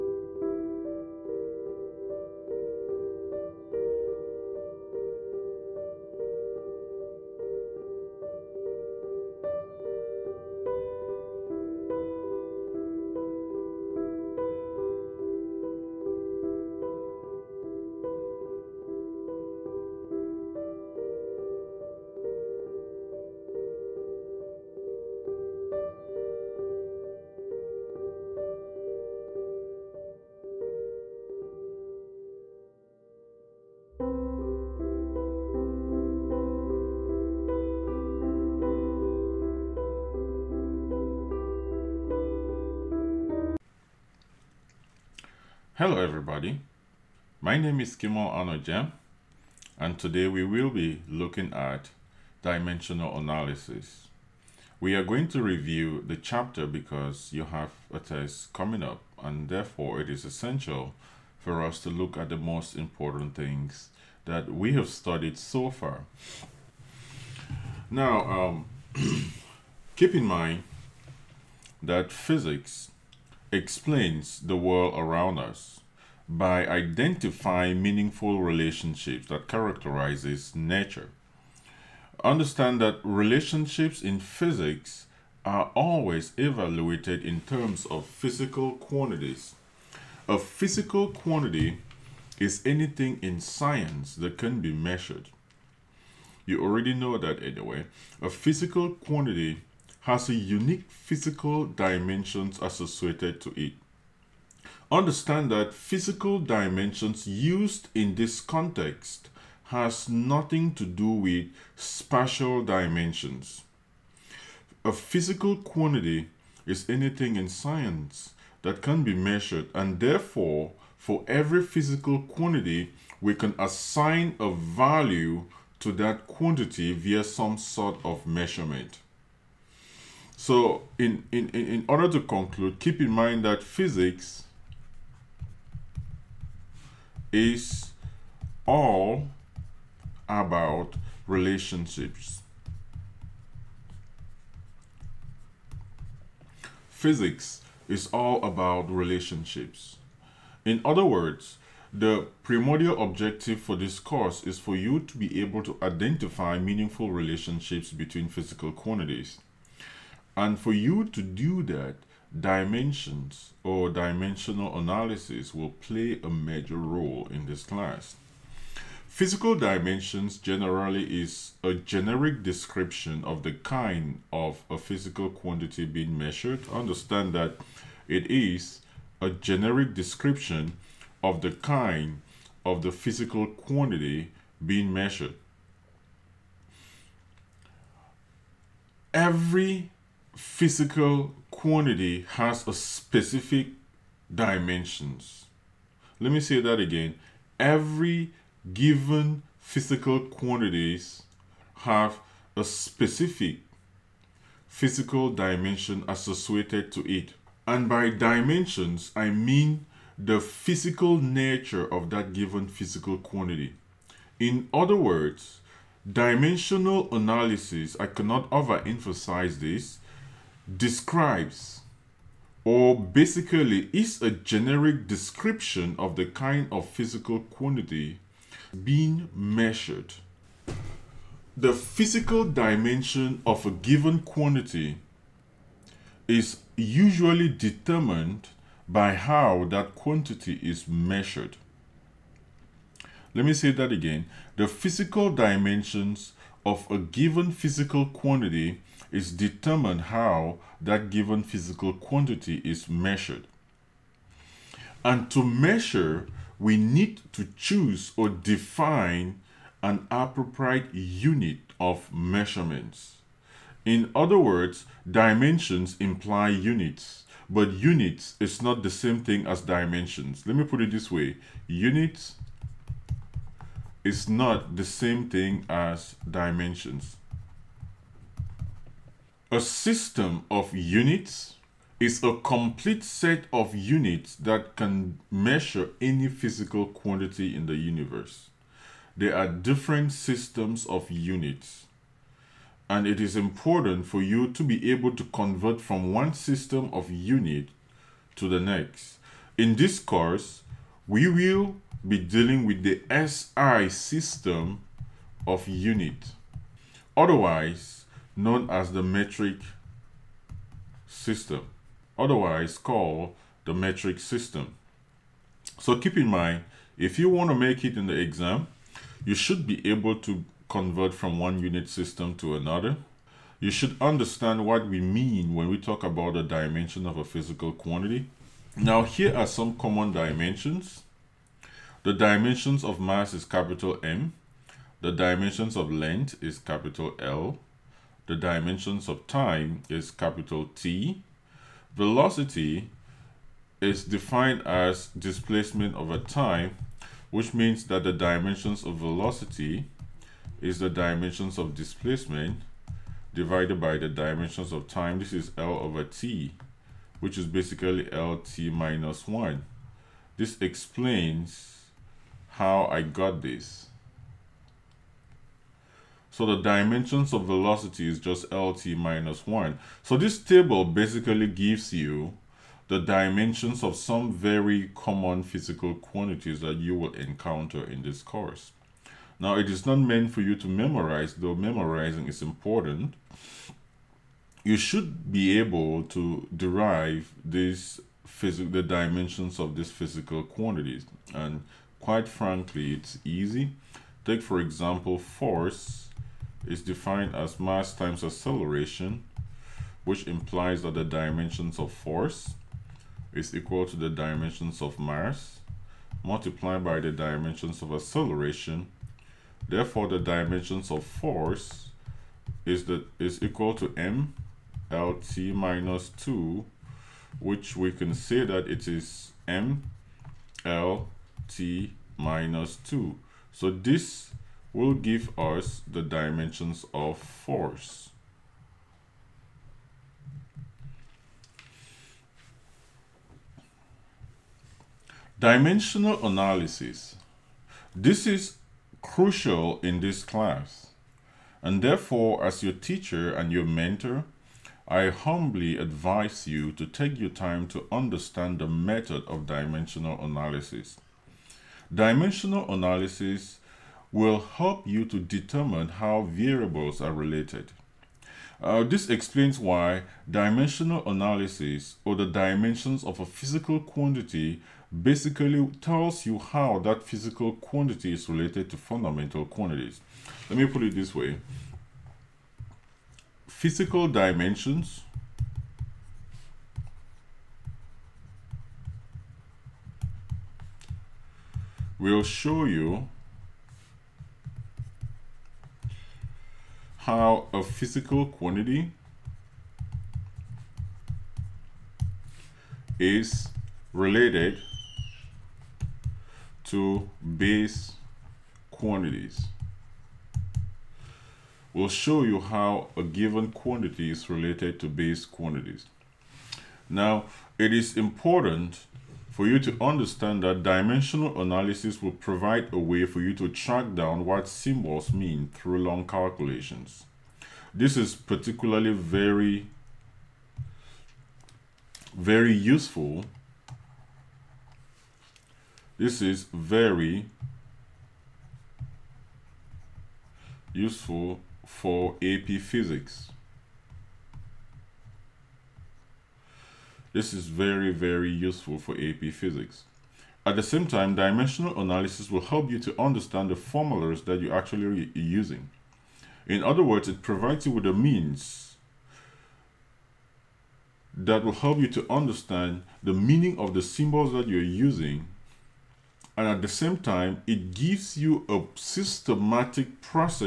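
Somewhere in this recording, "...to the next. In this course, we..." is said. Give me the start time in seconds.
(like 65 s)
298 s.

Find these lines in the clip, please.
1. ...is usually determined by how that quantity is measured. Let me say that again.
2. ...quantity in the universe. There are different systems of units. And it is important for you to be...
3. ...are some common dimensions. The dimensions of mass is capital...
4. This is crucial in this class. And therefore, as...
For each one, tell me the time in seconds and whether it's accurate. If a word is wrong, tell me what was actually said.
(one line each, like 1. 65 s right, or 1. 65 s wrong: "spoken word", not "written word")
1. 236 s right
2. 286 s right
3. 329 s right
4. 437 s right.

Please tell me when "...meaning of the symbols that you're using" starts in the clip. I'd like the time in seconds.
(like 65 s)
553 s.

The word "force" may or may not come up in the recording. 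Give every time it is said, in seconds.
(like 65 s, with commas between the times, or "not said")
395 s, 401 s, 411 s, 427 s.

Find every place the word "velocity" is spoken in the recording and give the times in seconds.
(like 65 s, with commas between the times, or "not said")
341 s, 348 s, 367 s.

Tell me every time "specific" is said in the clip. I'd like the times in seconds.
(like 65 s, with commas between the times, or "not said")
192 s, 202 s.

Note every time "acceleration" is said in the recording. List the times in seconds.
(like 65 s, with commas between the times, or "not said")
398 s, 407 s.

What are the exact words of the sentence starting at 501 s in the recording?
We'll show you how a given quantity is related to base quantities.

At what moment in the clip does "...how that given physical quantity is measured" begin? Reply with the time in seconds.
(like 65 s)
250 s.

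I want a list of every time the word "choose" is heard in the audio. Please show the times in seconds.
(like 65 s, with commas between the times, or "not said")
257 s.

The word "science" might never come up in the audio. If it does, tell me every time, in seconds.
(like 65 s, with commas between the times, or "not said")
93 s, 117 s.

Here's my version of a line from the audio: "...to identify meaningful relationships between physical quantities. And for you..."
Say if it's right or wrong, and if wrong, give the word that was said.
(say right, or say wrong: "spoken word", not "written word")
right.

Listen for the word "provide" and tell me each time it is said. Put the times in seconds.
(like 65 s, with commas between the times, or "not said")
512 s, 547 s.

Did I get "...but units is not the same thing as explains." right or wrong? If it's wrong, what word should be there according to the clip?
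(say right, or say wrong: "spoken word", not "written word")
wrong: "dimensions", not "explains".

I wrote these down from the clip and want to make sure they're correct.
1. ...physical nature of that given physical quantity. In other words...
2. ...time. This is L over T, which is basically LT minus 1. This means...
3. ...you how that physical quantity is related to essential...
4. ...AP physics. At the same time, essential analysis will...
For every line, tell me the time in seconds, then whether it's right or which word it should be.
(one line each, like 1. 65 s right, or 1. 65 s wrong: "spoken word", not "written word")
1. 210 s right
2. 354 s wrong: "explains", not "means"
3. 466 s wrong: "fundamental", not "essential"
4. 538 s wrong: "dimensional", not "essential".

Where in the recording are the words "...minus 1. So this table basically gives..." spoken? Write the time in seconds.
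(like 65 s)
368 s.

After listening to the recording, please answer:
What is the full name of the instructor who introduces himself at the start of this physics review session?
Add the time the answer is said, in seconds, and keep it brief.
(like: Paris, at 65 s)
Kimo Anojem, at 47 s.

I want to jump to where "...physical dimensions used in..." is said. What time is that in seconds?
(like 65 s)
105 s.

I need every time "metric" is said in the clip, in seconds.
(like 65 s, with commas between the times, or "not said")
309 s, 313 s.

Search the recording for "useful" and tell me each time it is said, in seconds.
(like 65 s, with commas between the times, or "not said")
522 s, 530 s, 538 s.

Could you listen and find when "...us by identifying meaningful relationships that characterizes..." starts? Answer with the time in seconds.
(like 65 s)
75 s.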